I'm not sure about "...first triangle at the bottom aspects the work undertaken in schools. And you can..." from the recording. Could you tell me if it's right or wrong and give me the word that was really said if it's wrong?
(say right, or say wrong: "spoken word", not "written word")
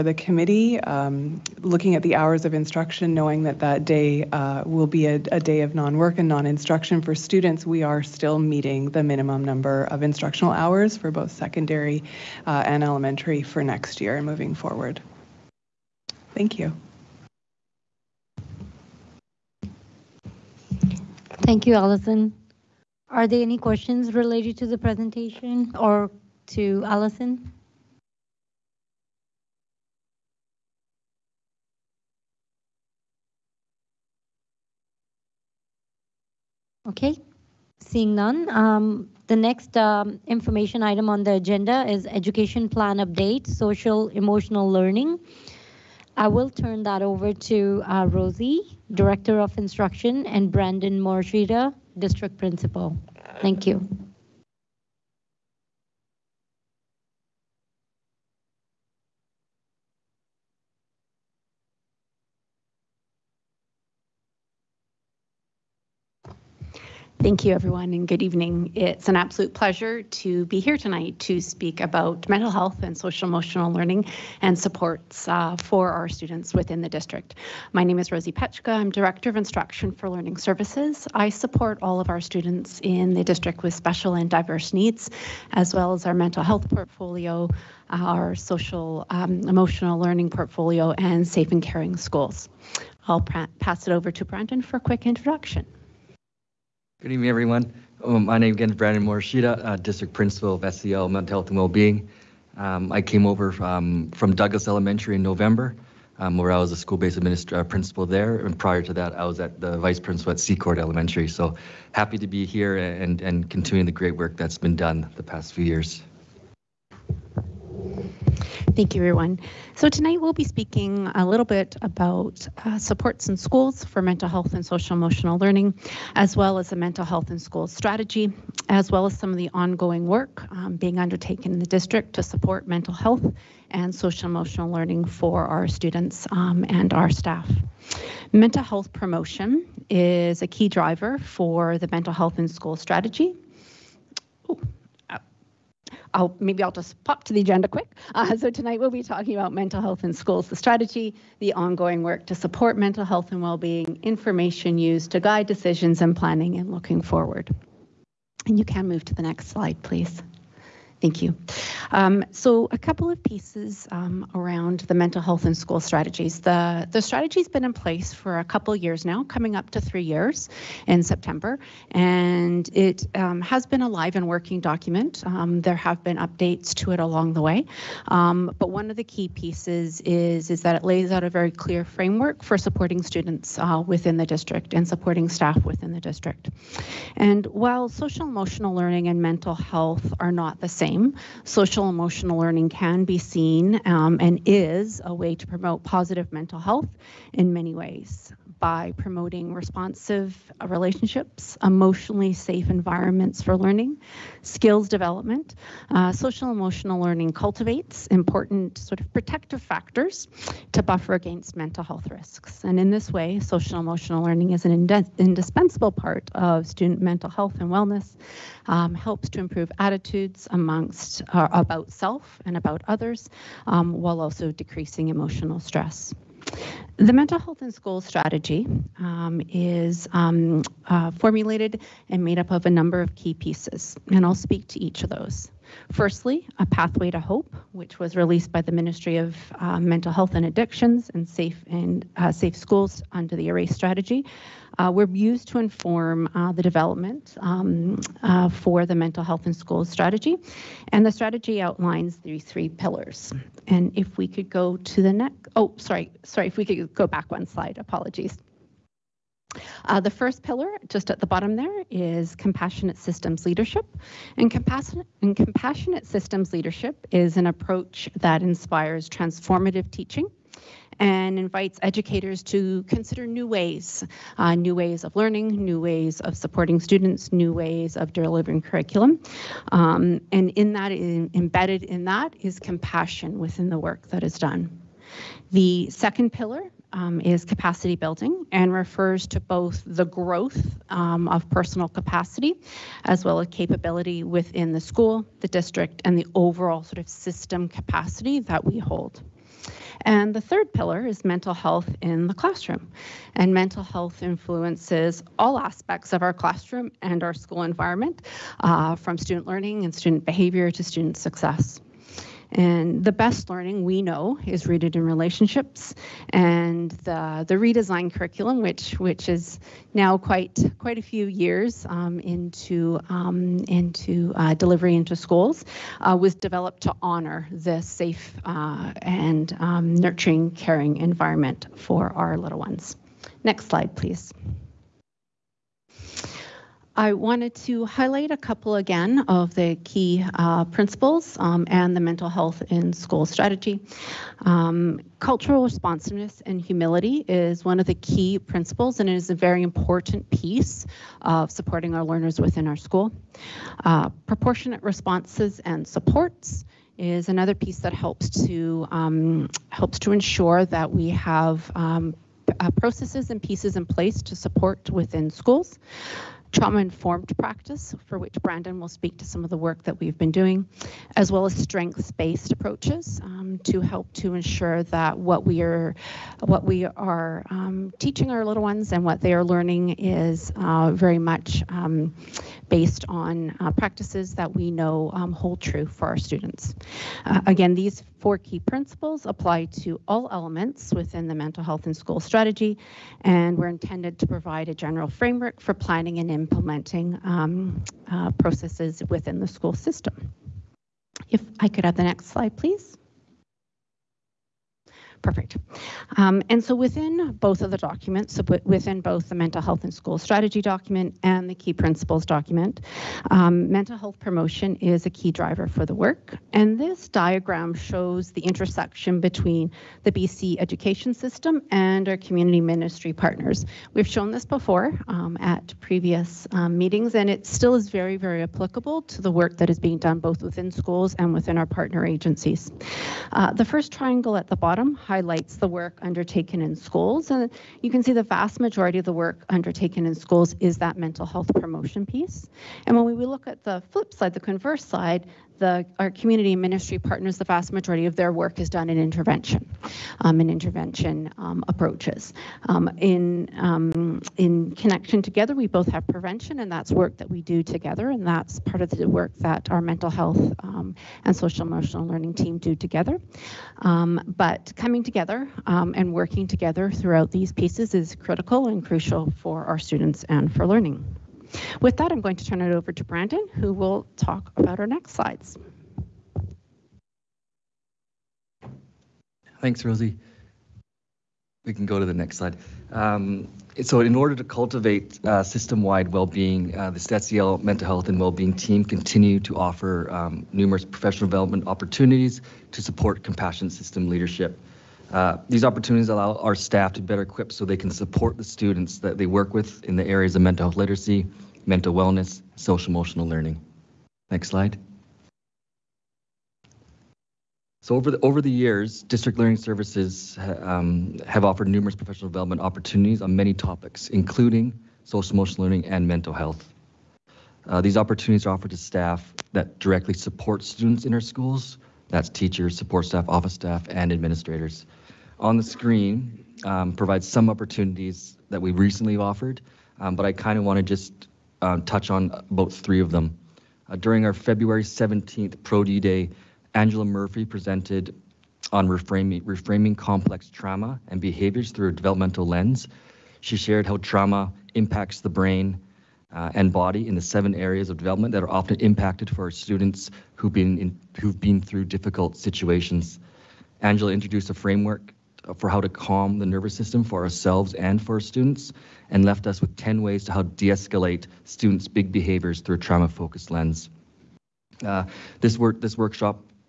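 wrong: "highlights", not "aspects".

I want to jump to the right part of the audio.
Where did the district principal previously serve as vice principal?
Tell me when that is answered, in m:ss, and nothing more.
1:50.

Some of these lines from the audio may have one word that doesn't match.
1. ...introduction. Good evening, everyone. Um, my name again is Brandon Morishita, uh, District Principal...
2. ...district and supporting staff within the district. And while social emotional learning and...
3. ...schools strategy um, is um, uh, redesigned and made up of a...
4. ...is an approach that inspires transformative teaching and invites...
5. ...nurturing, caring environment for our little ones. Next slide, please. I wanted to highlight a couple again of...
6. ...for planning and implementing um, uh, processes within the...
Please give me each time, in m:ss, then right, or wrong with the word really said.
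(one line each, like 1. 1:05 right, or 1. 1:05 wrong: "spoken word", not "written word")
1. 1:35 right
2. 3:04 right
3. 3:47 wrong: "formulated", not "redesigned"
4. 4:27 right
5. 5:29 right
6. 6:35 right.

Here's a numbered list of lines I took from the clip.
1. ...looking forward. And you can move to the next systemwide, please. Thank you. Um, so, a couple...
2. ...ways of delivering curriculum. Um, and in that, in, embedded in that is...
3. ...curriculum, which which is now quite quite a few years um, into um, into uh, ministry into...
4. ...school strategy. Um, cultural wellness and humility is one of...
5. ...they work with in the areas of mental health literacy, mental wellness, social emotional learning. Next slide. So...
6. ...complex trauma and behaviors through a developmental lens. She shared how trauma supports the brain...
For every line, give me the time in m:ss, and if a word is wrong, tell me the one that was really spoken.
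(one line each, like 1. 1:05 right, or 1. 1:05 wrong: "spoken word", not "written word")
1. 2:36 wrong: "slide", not "systemwide"
2. 4:37 right
3. 5:18 wrong: "delivery", not "ministry"
4. 5:42 wrong: "responsiveness", not "wellness"
5. 8:19 right
6. 8:59 wrong: "impacts", not "supports".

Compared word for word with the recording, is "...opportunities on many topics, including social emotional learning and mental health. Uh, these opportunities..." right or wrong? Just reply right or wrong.
right.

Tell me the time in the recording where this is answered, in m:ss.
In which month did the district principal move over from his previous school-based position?
1:45.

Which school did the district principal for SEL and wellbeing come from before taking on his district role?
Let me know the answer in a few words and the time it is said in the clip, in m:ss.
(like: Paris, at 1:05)
Douglas Elementary, at 1:44.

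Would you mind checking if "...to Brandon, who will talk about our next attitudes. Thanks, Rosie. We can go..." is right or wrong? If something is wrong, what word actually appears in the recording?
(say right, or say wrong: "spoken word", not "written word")
wrong: "slides", not "attitudes".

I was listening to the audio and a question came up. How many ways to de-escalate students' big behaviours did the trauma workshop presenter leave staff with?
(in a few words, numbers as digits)
10.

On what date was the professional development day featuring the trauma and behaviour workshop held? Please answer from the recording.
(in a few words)
February 17.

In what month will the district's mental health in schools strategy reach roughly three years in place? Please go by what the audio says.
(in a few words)
September.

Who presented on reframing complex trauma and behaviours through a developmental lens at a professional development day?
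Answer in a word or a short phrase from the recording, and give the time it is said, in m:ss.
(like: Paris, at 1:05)
Angela Murphy, at 8:56.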